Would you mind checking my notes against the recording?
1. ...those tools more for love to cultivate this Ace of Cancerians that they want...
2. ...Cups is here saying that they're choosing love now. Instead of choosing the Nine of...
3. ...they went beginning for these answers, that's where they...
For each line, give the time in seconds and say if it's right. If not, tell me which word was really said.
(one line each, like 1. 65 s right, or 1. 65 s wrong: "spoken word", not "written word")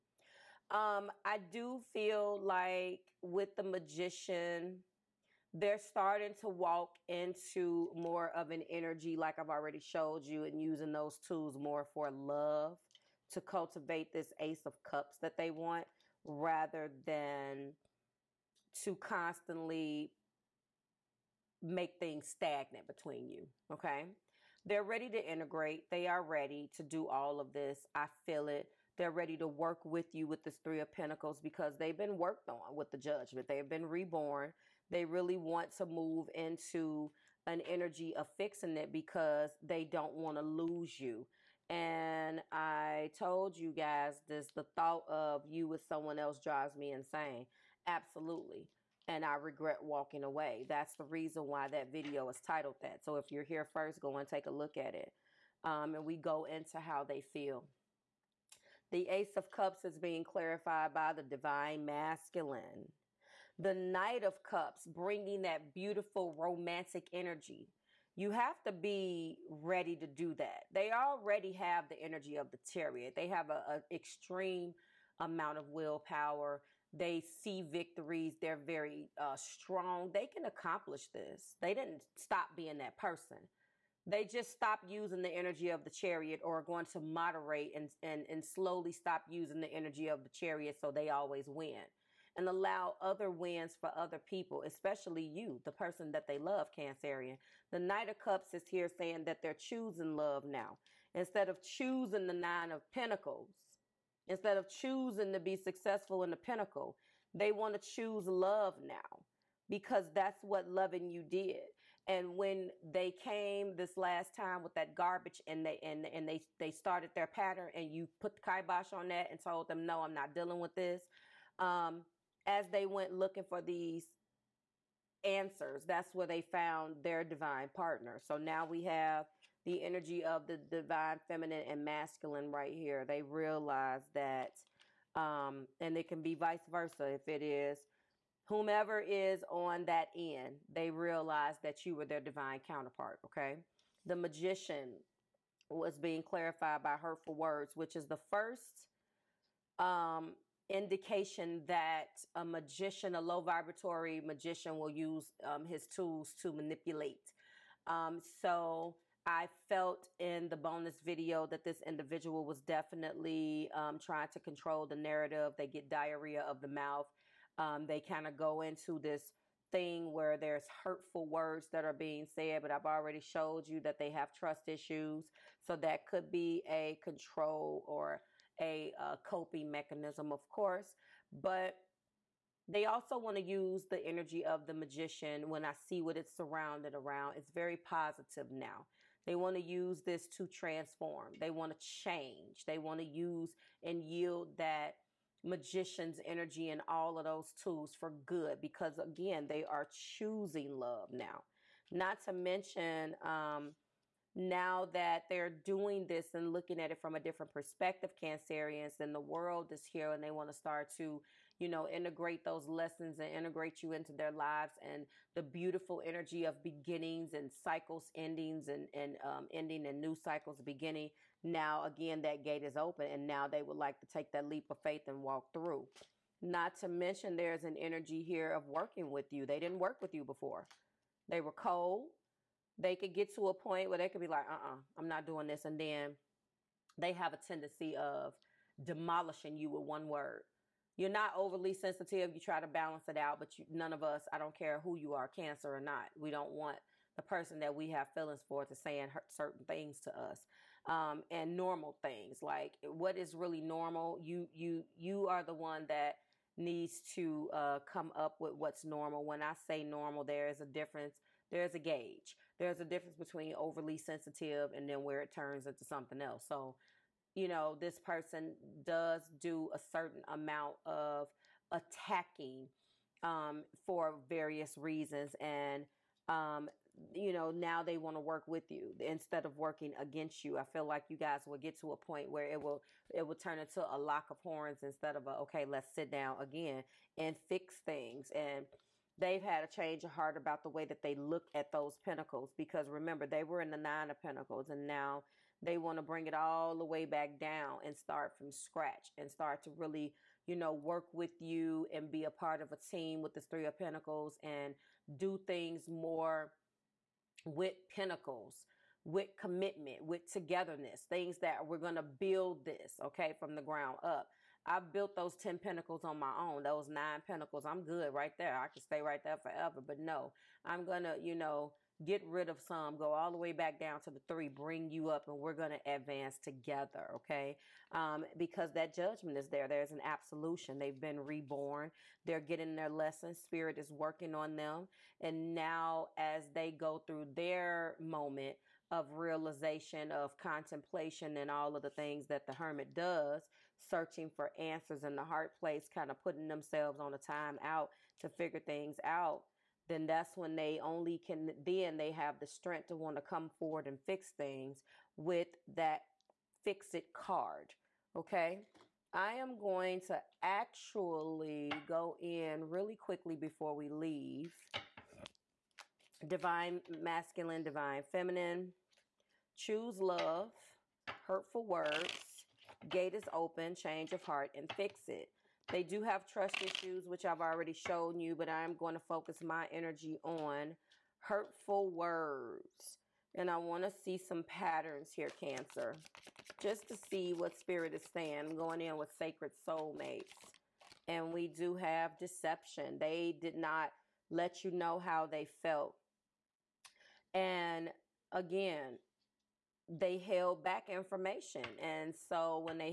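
1. 10 s wrong: "Cups", not "Cancerians"
2. 98 s right
3. 122 s wrong: "looking", not "beginning".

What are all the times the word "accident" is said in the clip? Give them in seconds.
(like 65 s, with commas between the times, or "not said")
not said.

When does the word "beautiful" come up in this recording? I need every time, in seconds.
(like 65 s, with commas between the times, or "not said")
65 s, 215 s.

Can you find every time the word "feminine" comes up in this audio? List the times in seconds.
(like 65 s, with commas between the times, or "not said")
131 s, 368 s.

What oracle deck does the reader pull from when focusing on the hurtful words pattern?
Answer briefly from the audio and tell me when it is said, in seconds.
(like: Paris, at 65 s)
Sacred Soulmates, at 389 s.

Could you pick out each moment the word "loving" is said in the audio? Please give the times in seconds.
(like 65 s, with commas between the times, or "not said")
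110 s.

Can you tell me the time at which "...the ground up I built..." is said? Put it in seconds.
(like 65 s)
313 s.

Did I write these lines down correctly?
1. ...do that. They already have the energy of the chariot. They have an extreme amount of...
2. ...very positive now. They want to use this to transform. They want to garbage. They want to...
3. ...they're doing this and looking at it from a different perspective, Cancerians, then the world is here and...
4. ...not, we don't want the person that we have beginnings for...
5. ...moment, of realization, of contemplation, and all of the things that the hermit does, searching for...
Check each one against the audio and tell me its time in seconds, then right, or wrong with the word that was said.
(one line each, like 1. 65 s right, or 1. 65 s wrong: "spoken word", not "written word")
1. 70 s right
2. 187 s wrong: "change", not "garbage"
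3. 205 s right
4. 245 s wrong: "feelings", not "beginnings"
5. 337 s right.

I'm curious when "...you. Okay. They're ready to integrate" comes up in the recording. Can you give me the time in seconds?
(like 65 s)
23 s.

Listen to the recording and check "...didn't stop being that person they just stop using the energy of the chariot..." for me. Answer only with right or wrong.
right.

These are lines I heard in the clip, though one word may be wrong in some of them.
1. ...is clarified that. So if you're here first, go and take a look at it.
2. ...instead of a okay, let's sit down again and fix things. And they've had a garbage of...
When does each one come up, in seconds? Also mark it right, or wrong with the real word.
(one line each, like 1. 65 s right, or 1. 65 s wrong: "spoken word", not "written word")
1. 52 s wrong: "titled", not "clarified"
2. 284 s wrong: "change", not "garbage".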